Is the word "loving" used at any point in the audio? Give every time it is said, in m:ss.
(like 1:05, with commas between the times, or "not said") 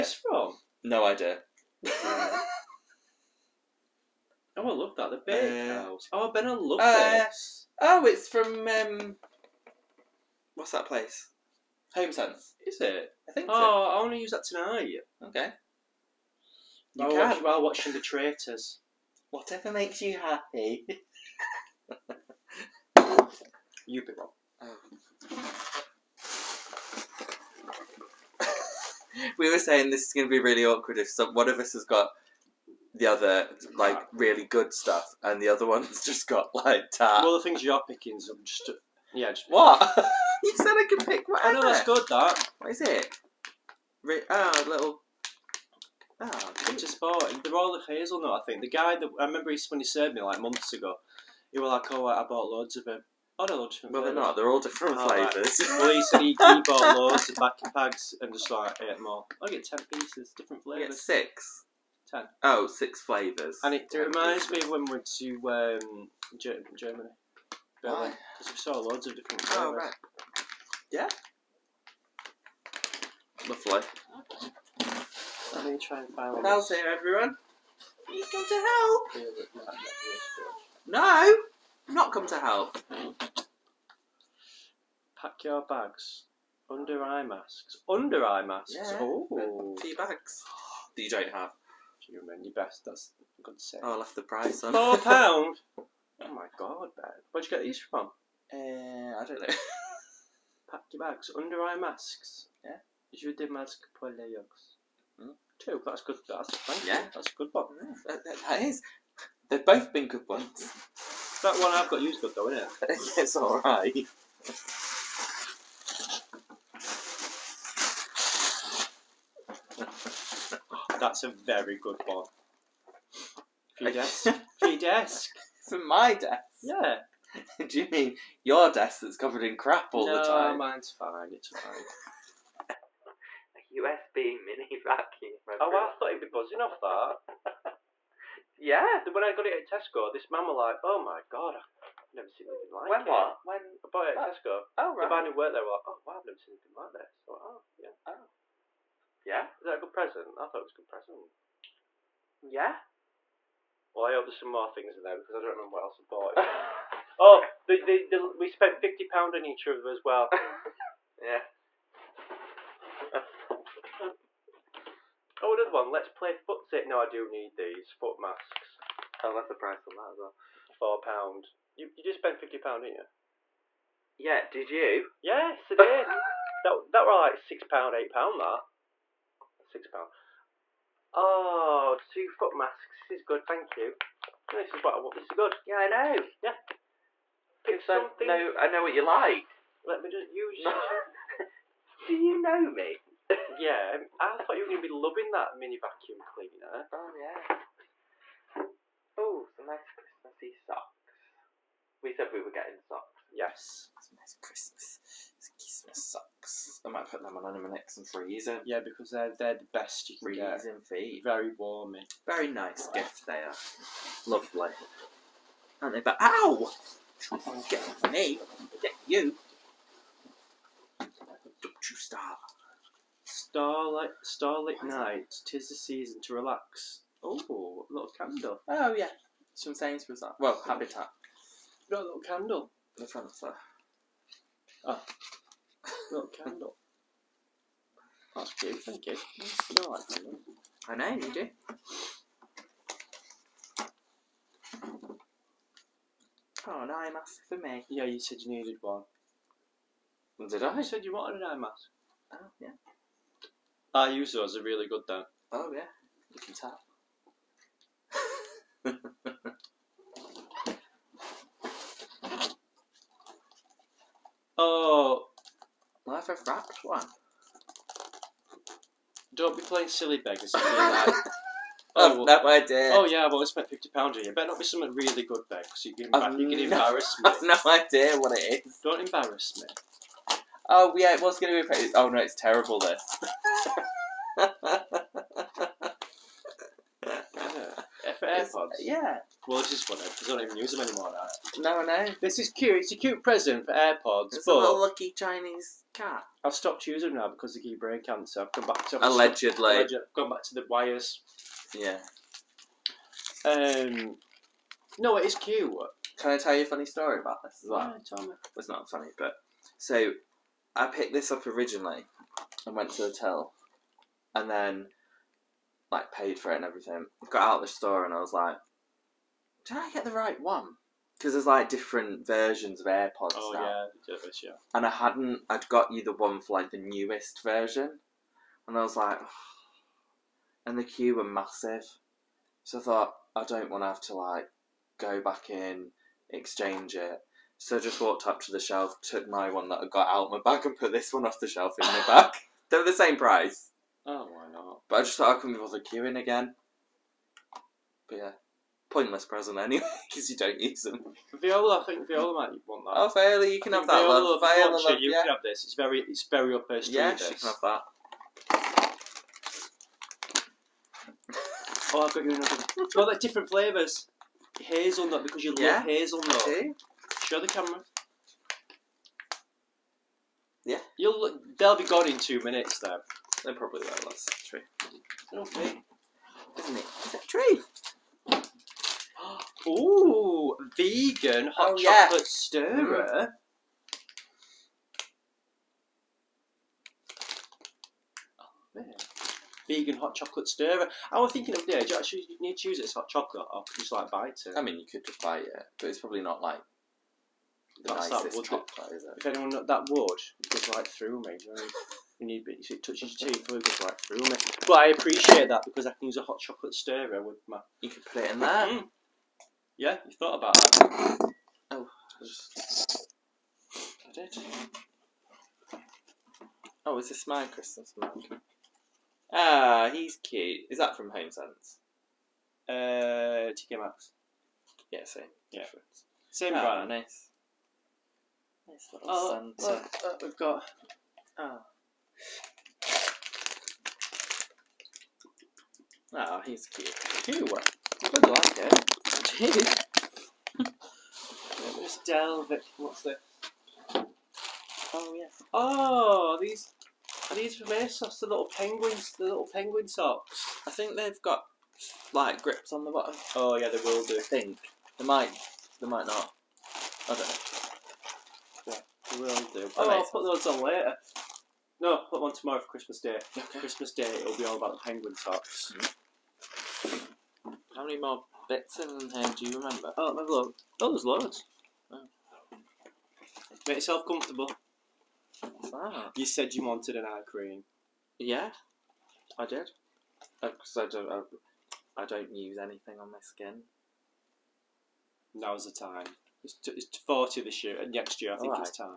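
3:14.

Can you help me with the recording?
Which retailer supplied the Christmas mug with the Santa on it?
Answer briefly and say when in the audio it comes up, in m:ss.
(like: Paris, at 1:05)
TK Maxx, at 7:03.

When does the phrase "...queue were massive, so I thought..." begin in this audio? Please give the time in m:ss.
5:30.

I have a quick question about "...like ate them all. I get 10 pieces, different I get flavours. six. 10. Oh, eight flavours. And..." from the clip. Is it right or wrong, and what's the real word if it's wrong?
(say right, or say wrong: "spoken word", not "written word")
wrong: "six", not "eight".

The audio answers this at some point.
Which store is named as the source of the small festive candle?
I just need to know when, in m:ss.
3:50.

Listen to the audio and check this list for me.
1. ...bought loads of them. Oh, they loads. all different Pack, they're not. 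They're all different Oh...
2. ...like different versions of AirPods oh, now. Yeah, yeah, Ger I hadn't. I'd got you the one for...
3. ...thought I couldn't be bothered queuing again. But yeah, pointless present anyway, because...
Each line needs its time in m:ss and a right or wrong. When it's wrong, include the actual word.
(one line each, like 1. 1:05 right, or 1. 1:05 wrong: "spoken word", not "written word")
1. 0:52 wrong: "Well", not "Pack"
2. 5:21 wrong: "And", not "Ger"
3. 5:45 right.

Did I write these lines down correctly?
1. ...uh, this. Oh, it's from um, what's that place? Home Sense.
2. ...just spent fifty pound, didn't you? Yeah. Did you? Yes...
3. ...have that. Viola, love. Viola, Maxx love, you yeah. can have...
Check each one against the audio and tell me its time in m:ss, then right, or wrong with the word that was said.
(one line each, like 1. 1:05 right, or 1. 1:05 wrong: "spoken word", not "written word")
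1. 0:06 right
2. 2:52 right
3. 5:53 wrong: "Viola", not "Maxx".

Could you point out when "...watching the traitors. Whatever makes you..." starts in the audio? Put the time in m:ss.
0:17.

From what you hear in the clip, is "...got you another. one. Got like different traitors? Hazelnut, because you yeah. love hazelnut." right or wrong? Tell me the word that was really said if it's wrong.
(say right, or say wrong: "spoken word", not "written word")
wrong: "flavours", not "traitors".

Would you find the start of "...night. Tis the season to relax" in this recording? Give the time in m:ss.
3:44.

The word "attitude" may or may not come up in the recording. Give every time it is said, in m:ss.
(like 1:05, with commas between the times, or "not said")
not said.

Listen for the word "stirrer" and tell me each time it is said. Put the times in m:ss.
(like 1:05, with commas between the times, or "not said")
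6:22, 6:30, 6:46.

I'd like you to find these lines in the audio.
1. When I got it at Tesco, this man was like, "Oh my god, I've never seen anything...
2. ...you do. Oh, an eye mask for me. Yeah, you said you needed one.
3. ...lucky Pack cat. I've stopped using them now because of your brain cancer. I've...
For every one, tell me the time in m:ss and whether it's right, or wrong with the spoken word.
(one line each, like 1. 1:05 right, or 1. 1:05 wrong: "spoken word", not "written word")
1. 2:19 right
2. 4:01 right
3. 4:54 wrong: "Chinese", not "Pack".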